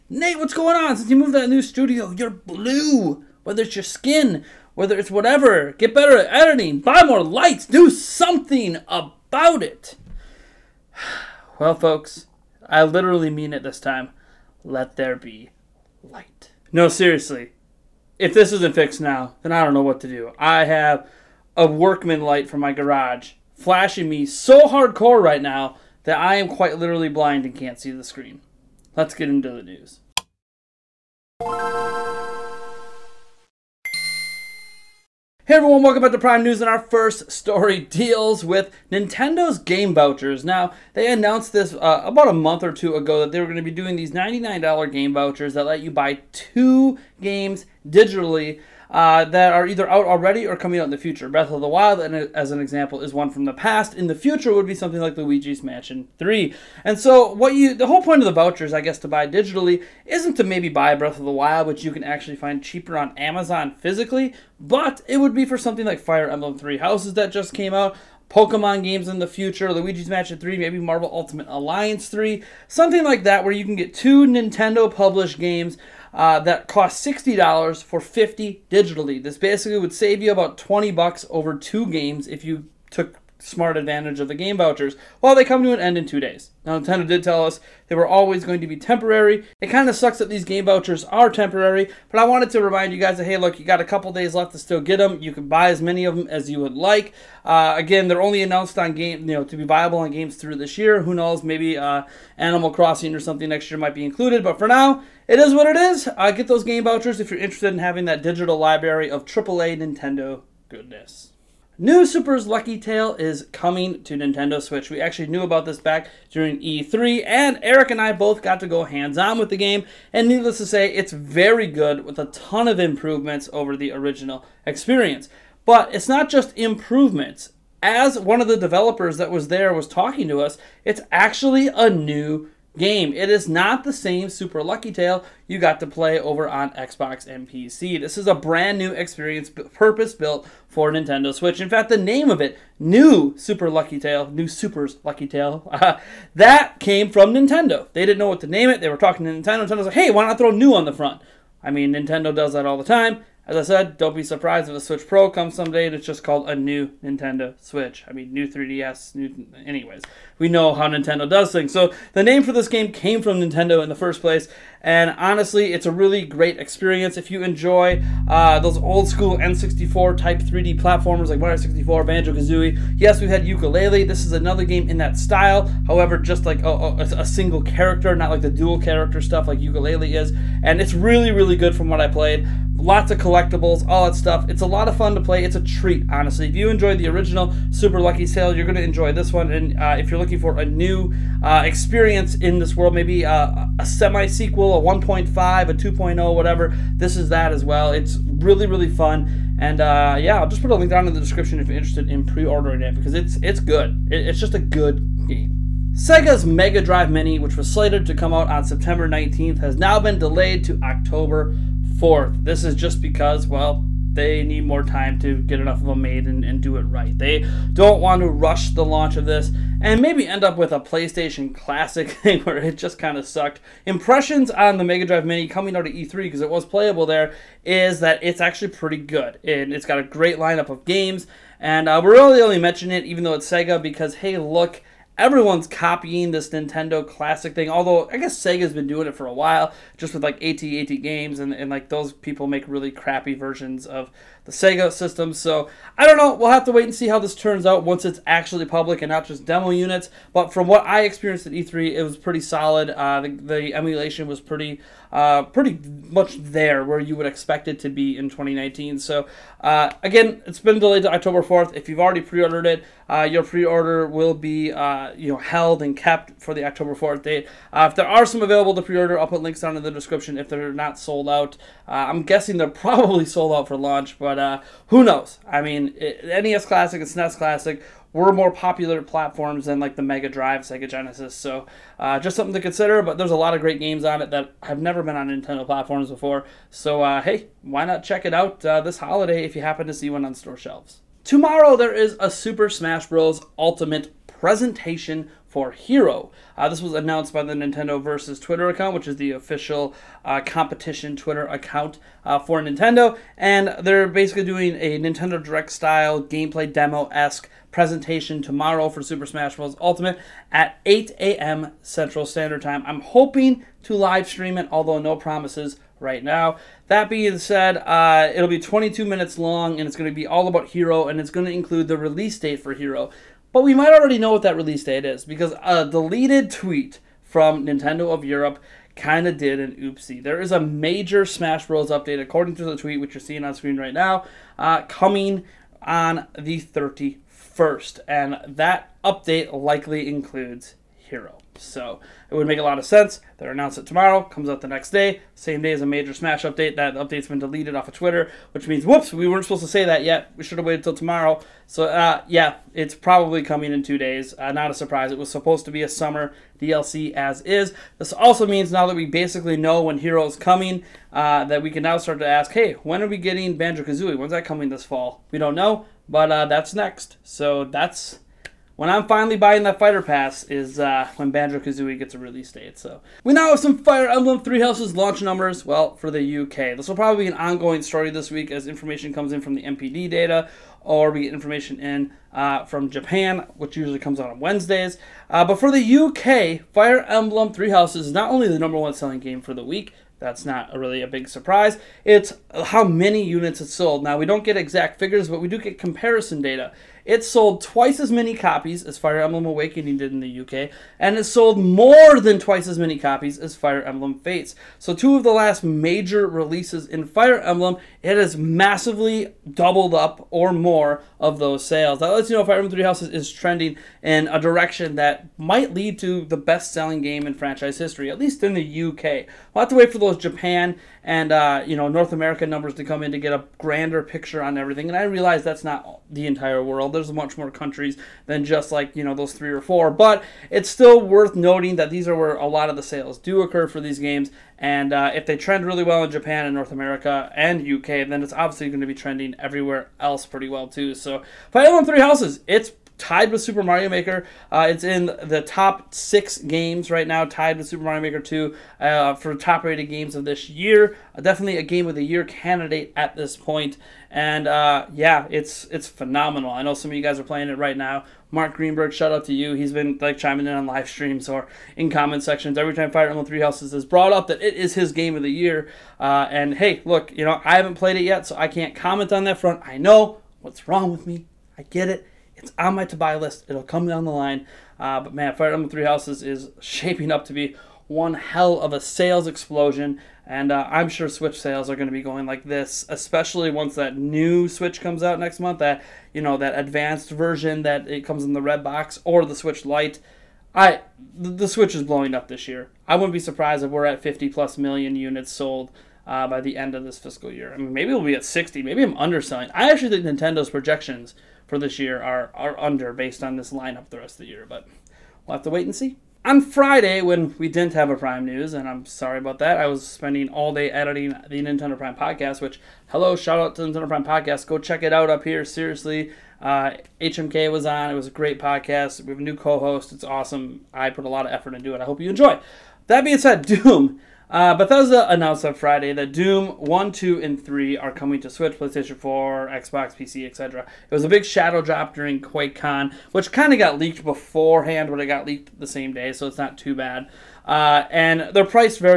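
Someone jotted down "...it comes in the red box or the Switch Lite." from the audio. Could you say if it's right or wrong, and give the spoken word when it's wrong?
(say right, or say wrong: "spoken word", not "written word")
right.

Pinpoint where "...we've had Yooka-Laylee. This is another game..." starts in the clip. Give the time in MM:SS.
02:53.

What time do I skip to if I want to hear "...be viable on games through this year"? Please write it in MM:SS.
01:39.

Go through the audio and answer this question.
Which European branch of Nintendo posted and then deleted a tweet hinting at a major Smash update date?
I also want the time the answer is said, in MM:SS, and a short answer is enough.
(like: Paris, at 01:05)
Nintendo of Europe, at 05:27.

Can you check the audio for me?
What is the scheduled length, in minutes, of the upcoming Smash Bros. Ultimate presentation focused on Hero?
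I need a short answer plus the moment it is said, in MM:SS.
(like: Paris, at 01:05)
22, at 05:18.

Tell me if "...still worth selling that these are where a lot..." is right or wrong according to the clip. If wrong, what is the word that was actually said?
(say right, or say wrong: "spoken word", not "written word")
wrong: "noting", not "selling".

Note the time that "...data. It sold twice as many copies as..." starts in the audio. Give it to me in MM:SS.
06:36.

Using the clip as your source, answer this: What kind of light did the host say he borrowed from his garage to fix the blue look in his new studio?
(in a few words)
workman light.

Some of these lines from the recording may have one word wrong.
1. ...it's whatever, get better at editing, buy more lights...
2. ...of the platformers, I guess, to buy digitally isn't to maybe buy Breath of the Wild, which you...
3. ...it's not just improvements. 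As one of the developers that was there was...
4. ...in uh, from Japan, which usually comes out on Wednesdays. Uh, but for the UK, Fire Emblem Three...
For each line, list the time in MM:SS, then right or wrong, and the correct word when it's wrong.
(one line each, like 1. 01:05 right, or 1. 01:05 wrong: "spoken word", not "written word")
1. 00:04 right
2. 00:58 wrong: "vouchers", not "platformers"
3. 02:05 right
4. 06:21 right.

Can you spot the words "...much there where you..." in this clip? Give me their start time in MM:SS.
04:16.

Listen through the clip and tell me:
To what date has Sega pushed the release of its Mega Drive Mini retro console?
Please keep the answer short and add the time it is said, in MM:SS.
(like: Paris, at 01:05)
October 4, at 03:30.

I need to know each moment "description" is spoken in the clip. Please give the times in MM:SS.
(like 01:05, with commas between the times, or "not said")
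03:21, 04:29.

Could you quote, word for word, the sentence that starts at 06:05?
We don't know, but uh, that's next.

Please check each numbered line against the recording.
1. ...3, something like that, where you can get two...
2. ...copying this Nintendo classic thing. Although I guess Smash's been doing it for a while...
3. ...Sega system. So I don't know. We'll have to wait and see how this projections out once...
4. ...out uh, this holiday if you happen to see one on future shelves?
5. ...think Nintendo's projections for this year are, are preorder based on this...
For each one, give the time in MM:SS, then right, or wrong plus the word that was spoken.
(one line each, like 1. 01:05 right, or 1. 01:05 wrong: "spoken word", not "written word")
1. 01:12 right
2. 03:55 wrong: "Sega", not "Smash"
3. 04:04 wrong: "turns", not "projections"
4. 04:48 wrong: "store", not "future"
5. 08:19 wrong: "under", not "preorder".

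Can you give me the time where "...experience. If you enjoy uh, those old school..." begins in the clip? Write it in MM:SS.
02:46.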